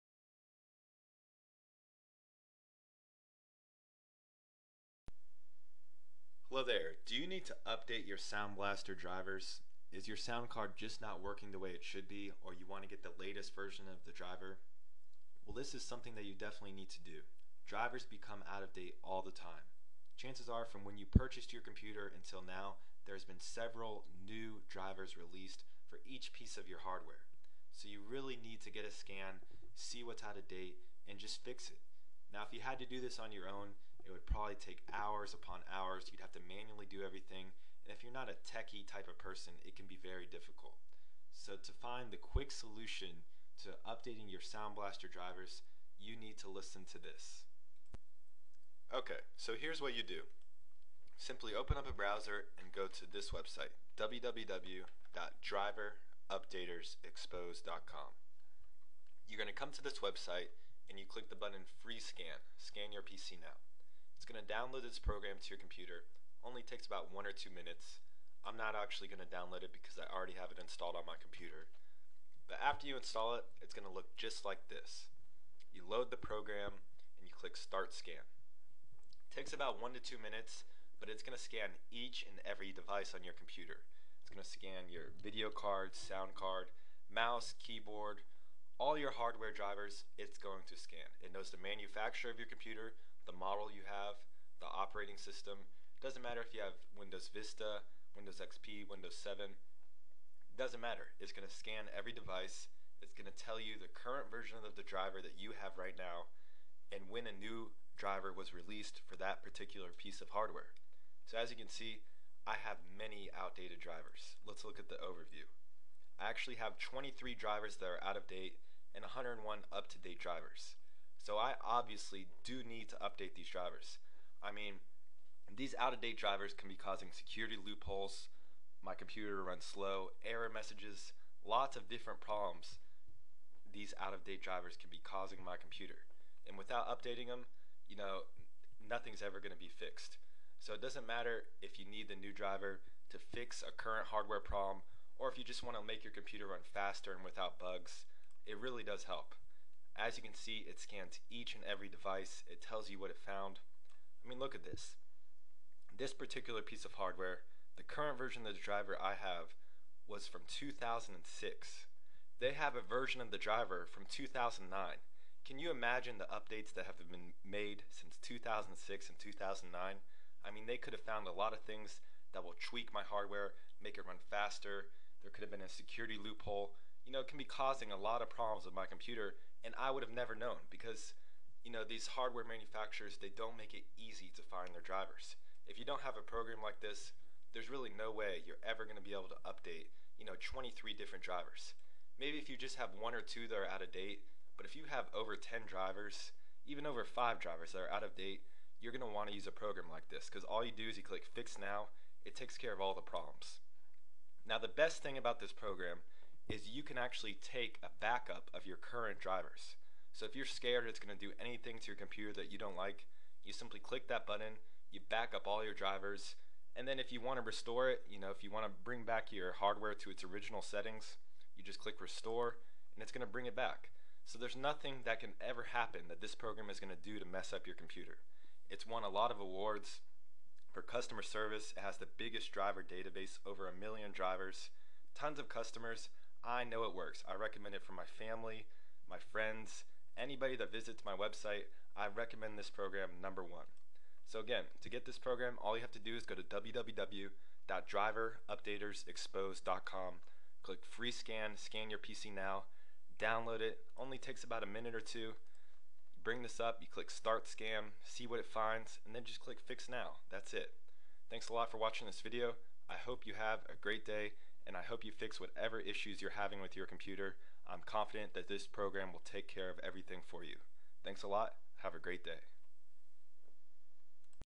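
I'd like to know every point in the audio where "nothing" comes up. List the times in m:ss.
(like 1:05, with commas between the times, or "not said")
2:18, 3:44.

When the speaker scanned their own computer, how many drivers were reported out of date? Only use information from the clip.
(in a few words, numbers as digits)
23.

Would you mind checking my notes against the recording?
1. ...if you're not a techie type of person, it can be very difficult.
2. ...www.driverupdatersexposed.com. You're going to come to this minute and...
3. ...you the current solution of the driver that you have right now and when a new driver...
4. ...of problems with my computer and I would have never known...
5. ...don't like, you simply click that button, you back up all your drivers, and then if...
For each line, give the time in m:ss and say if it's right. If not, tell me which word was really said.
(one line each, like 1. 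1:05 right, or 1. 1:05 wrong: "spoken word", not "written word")
1. 0:37 right
2. 0:53 wrong: "website", not "minute"
3. 1:43 wrong: "version", not "solution"
4. 2:58 right
5. 3:32 right.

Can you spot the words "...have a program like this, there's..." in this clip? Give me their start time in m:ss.
3:06.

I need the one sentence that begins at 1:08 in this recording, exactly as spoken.
I'm not actually going to download it because I already have it installed on my computer.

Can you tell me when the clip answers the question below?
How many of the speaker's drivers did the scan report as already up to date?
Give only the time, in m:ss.
1:59.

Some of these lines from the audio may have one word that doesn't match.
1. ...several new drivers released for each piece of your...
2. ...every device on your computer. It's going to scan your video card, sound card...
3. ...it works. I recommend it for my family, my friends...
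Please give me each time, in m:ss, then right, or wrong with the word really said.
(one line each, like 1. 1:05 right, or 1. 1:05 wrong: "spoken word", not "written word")
1. 0:23 right
2. 1:22 right
3. 3:56 right.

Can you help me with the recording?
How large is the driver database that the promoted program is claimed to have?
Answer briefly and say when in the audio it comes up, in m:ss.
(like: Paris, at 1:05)
over a million drivers, at 3:53.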